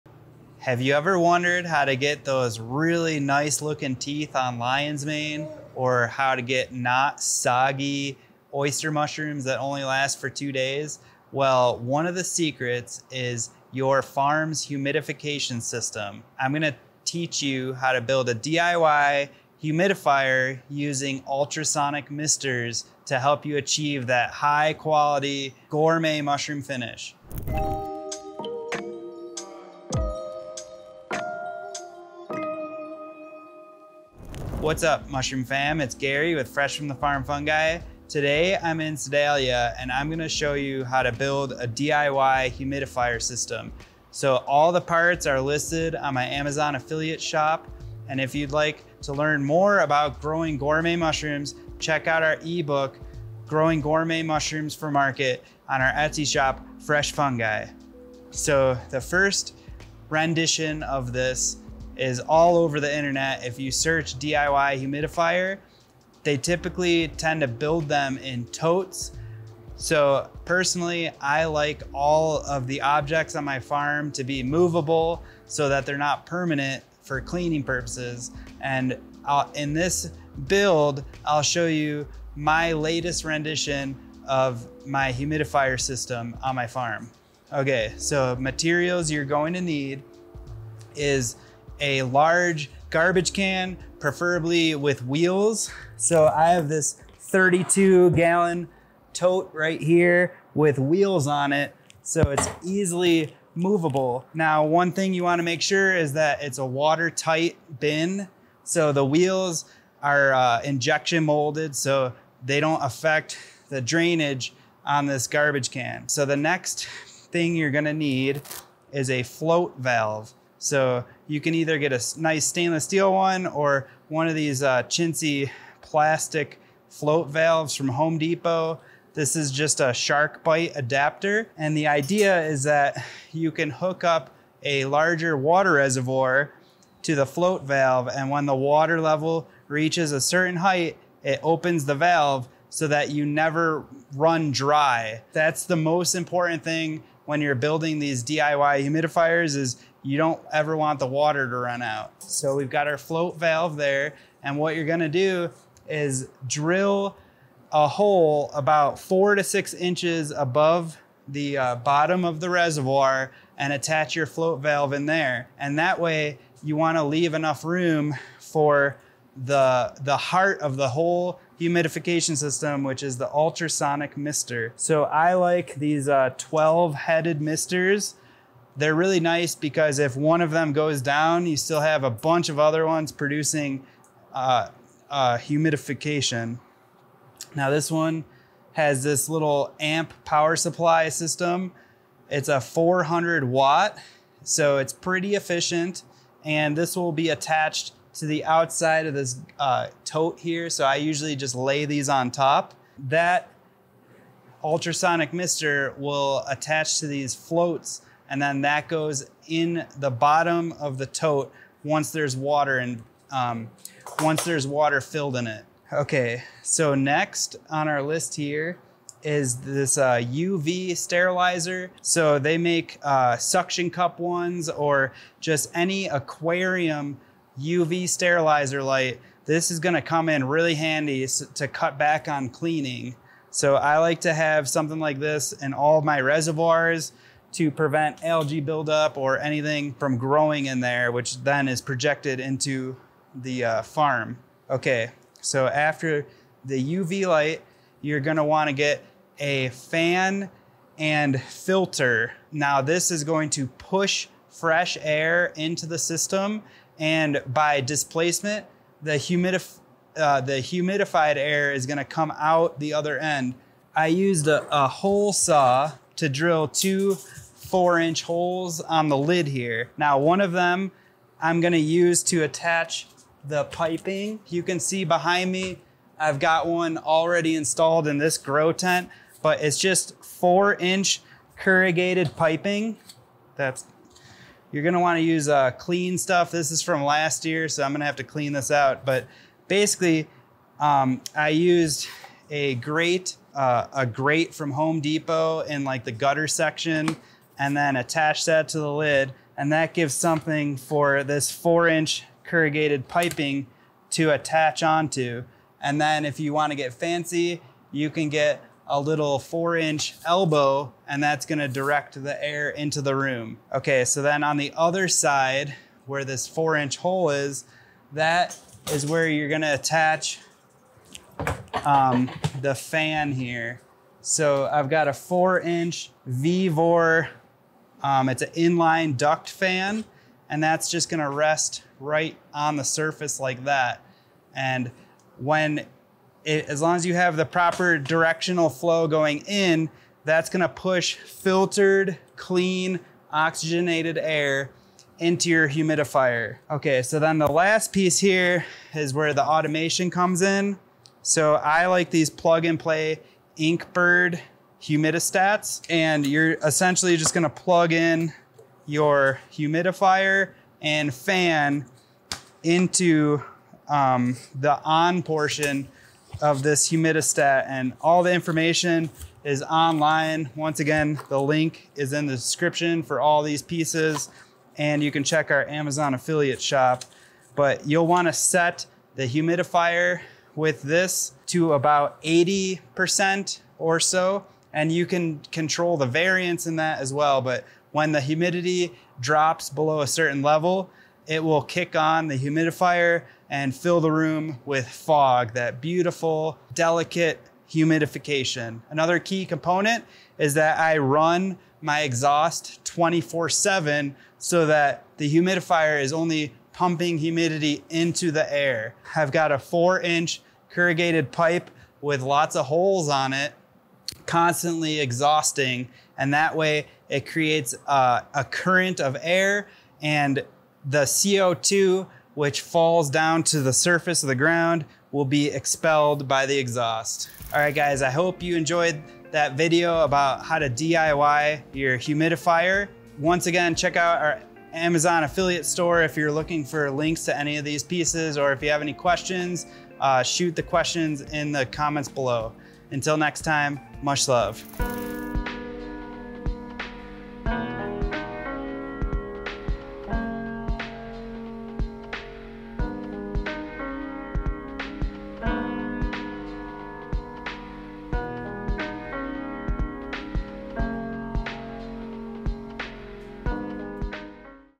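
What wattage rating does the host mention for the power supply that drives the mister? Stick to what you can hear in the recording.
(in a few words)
400 watt.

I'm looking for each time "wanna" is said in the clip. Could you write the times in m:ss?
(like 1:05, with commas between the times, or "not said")
1:45, 2:46, 4:08, 4:44, 5:06, 6:18.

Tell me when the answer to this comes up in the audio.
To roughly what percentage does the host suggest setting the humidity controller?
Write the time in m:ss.
6:22.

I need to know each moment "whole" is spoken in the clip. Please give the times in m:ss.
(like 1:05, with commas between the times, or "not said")
2:50.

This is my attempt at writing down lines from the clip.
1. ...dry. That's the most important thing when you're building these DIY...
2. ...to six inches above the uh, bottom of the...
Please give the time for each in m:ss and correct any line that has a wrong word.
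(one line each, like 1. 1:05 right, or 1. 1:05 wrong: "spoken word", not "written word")
1. 2:24 right
2. 2:39 right.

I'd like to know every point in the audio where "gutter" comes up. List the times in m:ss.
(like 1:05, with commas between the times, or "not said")
4:56.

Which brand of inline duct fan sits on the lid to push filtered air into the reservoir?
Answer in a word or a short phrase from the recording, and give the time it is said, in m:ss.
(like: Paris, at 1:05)
Vevor, at 5:26.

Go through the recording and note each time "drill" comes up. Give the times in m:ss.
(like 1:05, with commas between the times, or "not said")
2:36, 4:26.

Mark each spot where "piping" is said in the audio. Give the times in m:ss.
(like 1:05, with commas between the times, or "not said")
4:33, 4:42, 5:03.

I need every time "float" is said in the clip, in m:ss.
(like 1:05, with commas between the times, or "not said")
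1:59, 2:06, 2:17, 2:32, 2:44, 3:27.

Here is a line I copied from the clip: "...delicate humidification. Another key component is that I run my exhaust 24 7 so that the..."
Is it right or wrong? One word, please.
right.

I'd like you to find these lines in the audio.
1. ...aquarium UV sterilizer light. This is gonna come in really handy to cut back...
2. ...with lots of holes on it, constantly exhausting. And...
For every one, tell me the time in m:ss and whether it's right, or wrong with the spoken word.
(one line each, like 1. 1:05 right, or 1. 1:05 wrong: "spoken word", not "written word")
1. 3:46 right
2. 6:52 right.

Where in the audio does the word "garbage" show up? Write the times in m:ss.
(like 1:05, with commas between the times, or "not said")
1:32, 1:55.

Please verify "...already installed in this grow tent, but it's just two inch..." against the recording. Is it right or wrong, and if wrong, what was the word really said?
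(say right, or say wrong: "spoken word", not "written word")
wrong: "four", not "two".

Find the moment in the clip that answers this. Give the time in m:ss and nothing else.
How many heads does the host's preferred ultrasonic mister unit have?
2:56.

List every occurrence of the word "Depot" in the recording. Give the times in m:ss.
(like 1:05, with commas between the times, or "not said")
2:08, 4:55.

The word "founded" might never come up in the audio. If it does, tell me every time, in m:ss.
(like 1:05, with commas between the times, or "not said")
not said.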